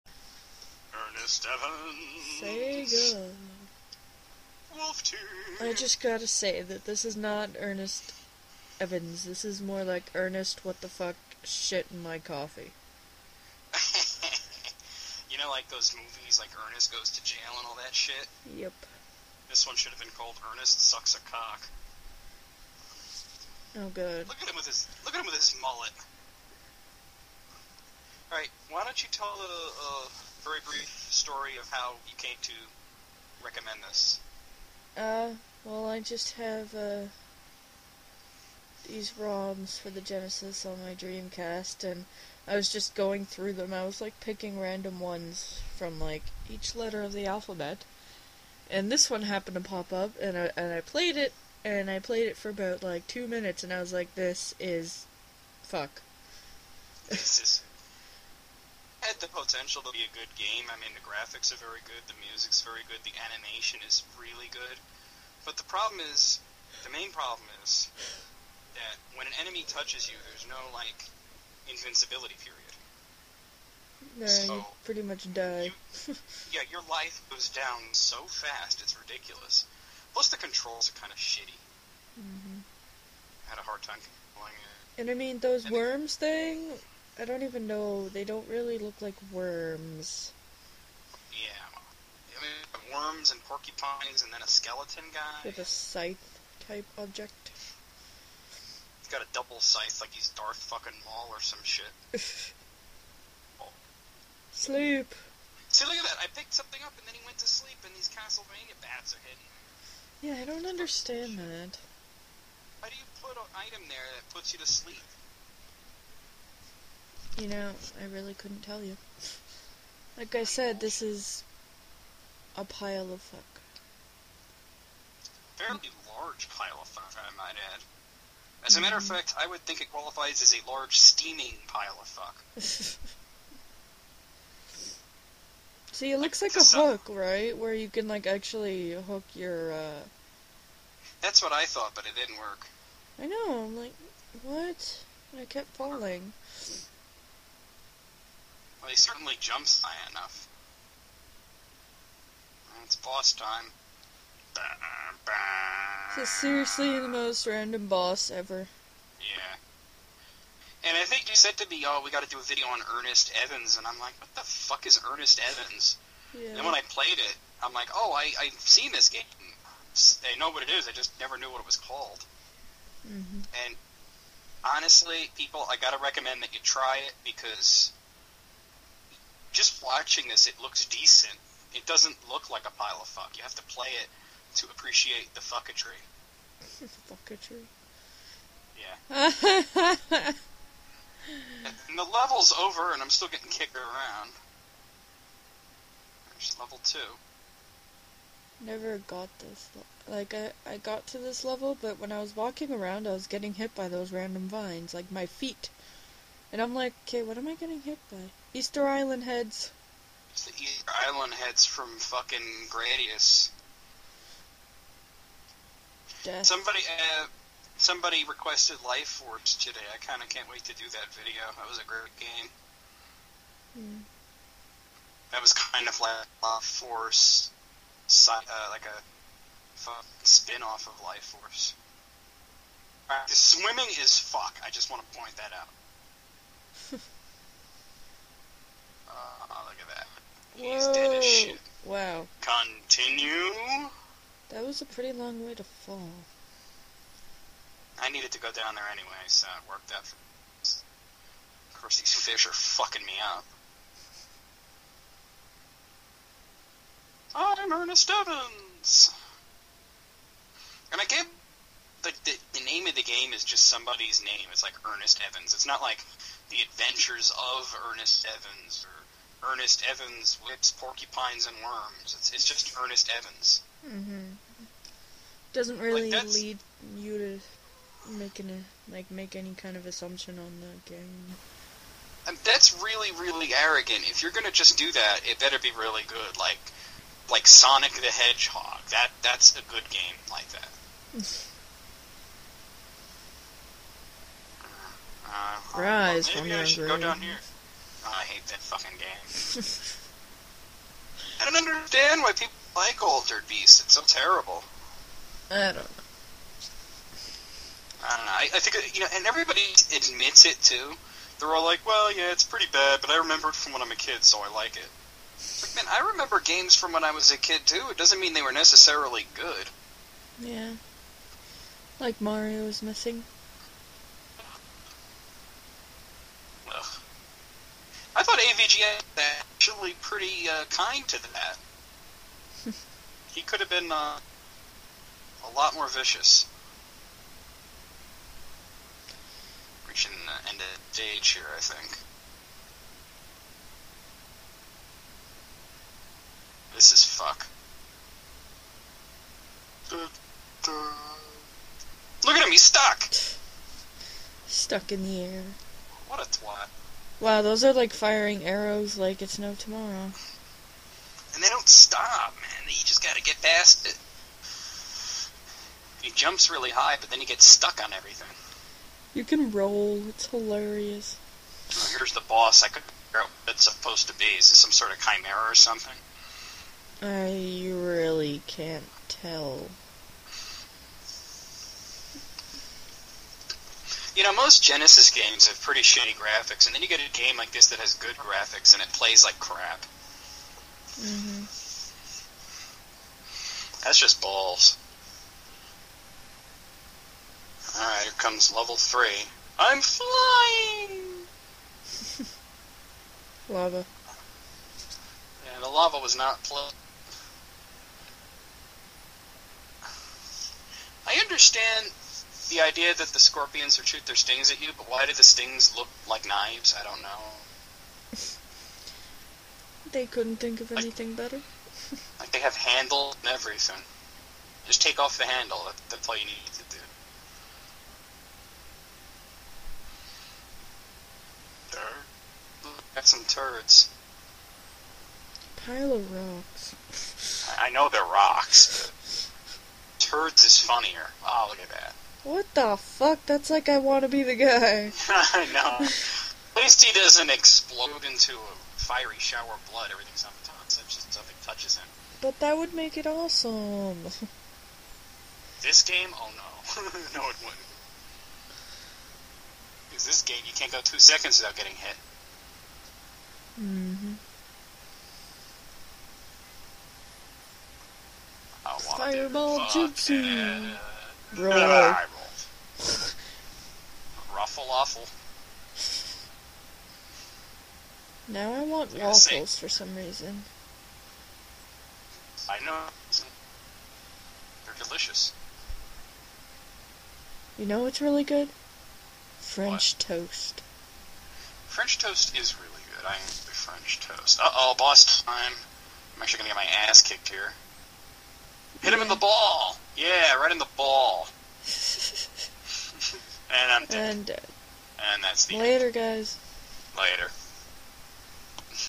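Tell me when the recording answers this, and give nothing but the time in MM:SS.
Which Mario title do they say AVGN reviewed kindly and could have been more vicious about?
05:22.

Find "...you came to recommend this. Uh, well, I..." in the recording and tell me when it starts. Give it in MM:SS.
00:32.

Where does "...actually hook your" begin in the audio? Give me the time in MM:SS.
02:18.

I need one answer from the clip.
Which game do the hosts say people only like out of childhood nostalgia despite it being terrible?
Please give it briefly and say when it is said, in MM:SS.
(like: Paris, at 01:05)
Altered Beast, at 05:03.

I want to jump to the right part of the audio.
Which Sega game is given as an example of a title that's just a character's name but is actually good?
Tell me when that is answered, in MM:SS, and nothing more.
04:47.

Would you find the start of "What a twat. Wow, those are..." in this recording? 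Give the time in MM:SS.
05:56.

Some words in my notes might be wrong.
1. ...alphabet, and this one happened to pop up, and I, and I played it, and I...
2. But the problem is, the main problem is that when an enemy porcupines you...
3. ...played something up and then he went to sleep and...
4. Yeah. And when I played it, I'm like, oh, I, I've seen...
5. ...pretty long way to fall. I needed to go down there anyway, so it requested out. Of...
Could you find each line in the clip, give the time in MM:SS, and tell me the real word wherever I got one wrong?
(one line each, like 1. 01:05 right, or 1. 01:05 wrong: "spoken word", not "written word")
1. 00:47 right
2. 01:05 wrong: "touches", not "porcupines"
3. 01:46 wrong: "picked", not "played"
4. 02:46 right
5. 04:04 wrong: "worked", not "requested".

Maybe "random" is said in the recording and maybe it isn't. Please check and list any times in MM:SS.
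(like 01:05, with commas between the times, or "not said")
00:44, 02:37, 03:24.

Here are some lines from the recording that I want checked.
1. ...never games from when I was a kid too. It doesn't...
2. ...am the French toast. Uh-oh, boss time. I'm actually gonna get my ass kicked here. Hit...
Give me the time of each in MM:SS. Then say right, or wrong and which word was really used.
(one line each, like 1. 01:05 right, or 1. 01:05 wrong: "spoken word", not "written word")
1. 05:16 wrong: "remember", not "never"
2. 08:13 right.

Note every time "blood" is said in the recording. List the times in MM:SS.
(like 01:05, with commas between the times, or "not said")
07:29.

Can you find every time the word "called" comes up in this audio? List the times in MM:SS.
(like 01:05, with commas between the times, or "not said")
00:20, 02:51.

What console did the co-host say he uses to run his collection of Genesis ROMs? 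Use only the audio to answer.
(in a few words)
Dreamcast.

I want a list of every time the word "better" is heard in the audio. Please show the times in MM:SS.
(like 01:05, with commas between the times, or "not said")
04:45, 07:01.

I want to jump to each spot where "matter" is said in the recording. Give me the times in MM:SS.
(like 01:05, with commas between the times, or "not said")
02:08.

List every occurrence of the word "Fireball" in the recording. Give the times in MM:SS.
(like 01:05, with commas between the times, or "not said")
07:48.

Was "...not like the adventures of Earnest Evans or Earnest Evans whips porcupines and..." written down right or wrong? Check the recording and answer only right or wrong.
right.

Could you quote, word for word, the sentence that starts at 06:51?
I understand the idea that the scorpions would shoot their stings at you, but why do the stings look like knives?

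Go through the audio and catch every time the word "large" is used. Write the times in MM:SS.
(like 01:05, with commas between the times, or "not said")
02:06, 02:10.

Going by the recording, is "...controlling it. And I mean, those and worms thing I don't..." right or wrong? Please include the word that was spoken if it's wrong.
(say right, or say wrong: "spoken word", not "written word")
right.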